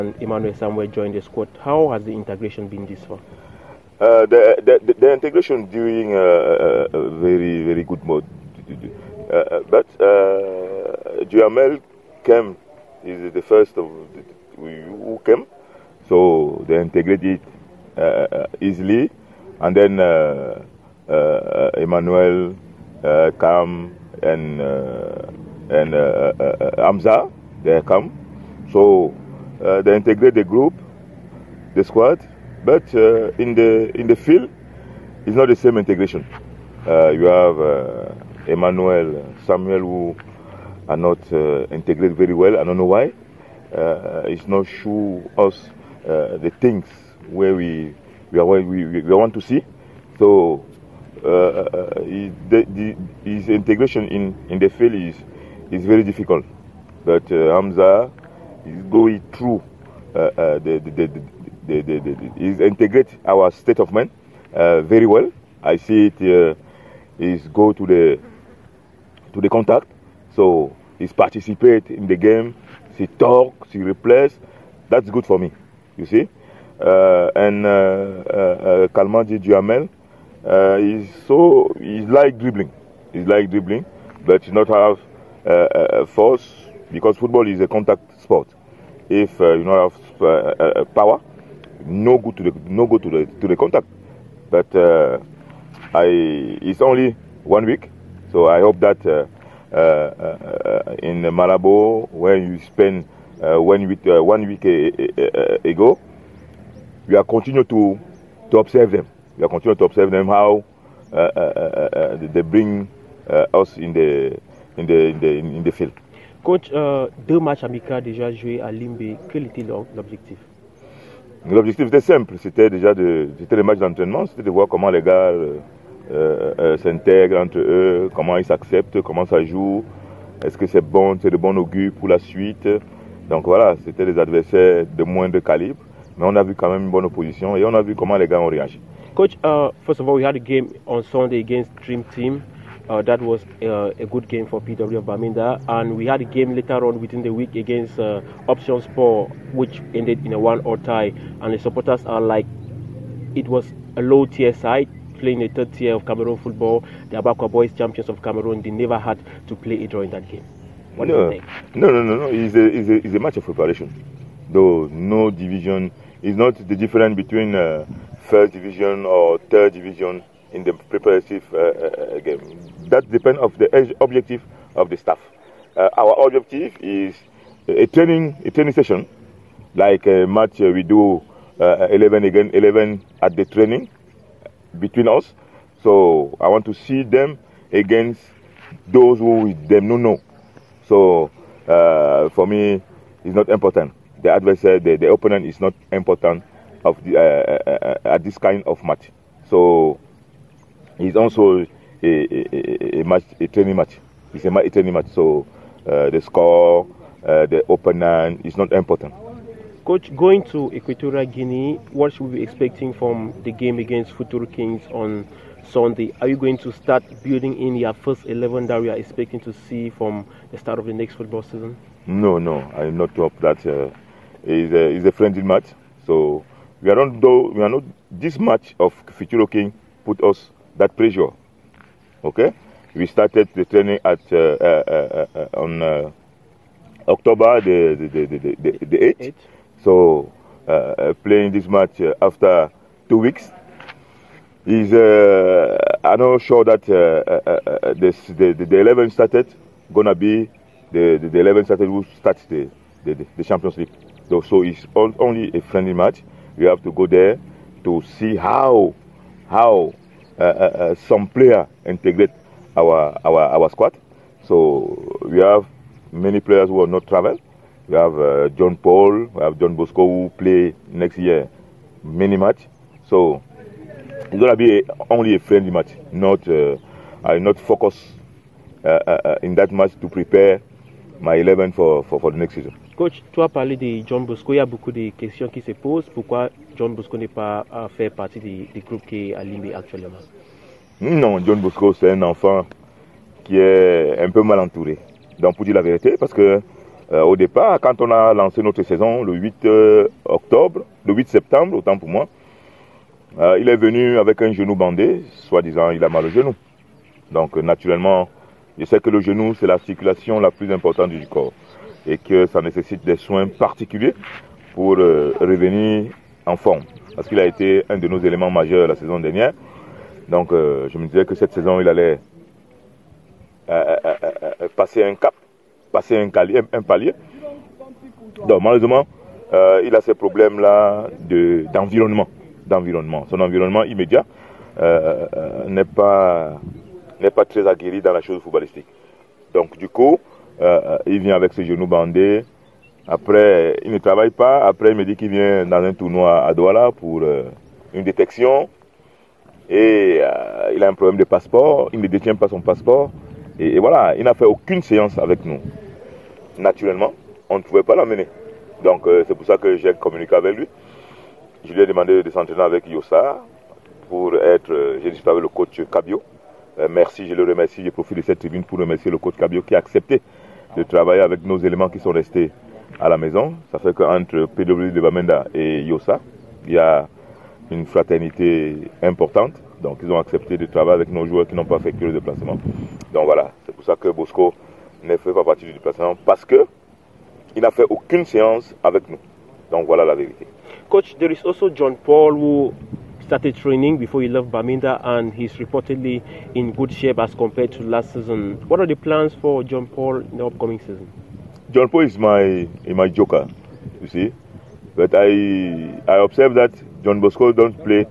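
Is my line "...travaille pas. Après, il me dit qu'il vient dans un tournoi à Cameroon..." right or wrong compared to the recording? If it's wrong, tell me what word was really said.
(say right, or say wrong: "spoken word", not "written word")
wrong: "Douala", not "Cameroon".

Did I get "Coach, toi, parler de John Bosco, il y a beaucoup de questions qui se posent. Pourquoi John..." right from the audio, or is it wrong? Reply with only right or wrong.
right.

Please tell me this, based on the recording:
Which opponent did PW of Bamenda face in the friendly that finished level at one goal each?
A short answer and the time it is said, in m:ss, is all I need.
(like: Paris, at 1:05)
Options Sport, at 2:28.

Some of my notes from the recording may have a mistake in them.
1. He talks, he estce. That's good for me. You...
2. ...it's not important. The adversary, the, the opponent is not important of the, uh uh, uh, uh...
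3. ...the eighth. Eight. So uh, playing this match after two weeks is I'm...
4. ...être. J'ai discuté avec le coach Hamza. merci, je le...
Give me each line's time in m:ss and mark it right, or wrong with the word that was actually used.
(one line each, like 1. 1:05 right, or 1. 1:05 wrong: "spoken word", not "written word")
1. 1:12 wrong: "replace", not "estce"
2. 3:13 right
3. 3:58 right
4. 6:04 wrong: "Cabio", not "Hamza".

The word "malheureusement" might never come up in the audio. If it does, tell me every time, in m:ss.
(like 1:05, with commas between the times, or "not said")
5:28.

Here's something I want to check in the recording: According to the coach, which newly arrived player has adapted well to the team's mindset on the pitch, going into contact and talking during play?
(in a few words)
Hamza.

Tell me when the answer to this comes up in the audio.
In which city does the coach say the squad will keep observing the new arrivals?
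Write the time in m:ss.
1:41.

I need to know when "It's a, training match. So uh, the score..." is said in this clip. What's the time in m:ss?
3:24.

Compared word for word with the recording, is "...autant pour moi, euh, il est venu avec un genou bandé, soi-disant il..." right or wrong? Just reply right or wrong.
right.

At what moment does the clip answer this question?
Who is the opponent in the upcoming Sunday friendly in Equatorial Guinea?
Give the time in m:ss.
3:34.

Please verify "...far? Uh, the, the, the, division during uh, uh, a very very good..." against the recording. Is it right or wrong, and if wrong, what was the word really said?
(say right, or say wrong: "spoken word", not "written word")
wrong: "integration", not "division".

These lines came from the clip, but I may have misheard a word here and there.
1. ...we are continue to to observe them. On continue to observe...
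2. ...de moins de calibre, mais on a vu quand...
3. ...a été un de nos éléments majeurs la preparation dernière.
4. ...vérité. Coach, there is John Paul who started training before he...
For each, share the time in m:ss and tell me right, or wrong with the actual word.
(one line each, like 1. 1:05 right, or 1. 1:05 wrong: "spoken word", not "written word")
1. 1:47 right
2. 2:14 right
3. 5:17 wrong: "saison", not "preparation"
4. 6:30 right.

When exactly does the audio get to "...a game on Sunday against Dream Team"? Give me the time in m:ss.
2:20.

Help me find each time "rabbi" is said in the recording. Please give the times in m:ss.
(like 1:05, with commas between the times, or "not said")
not said.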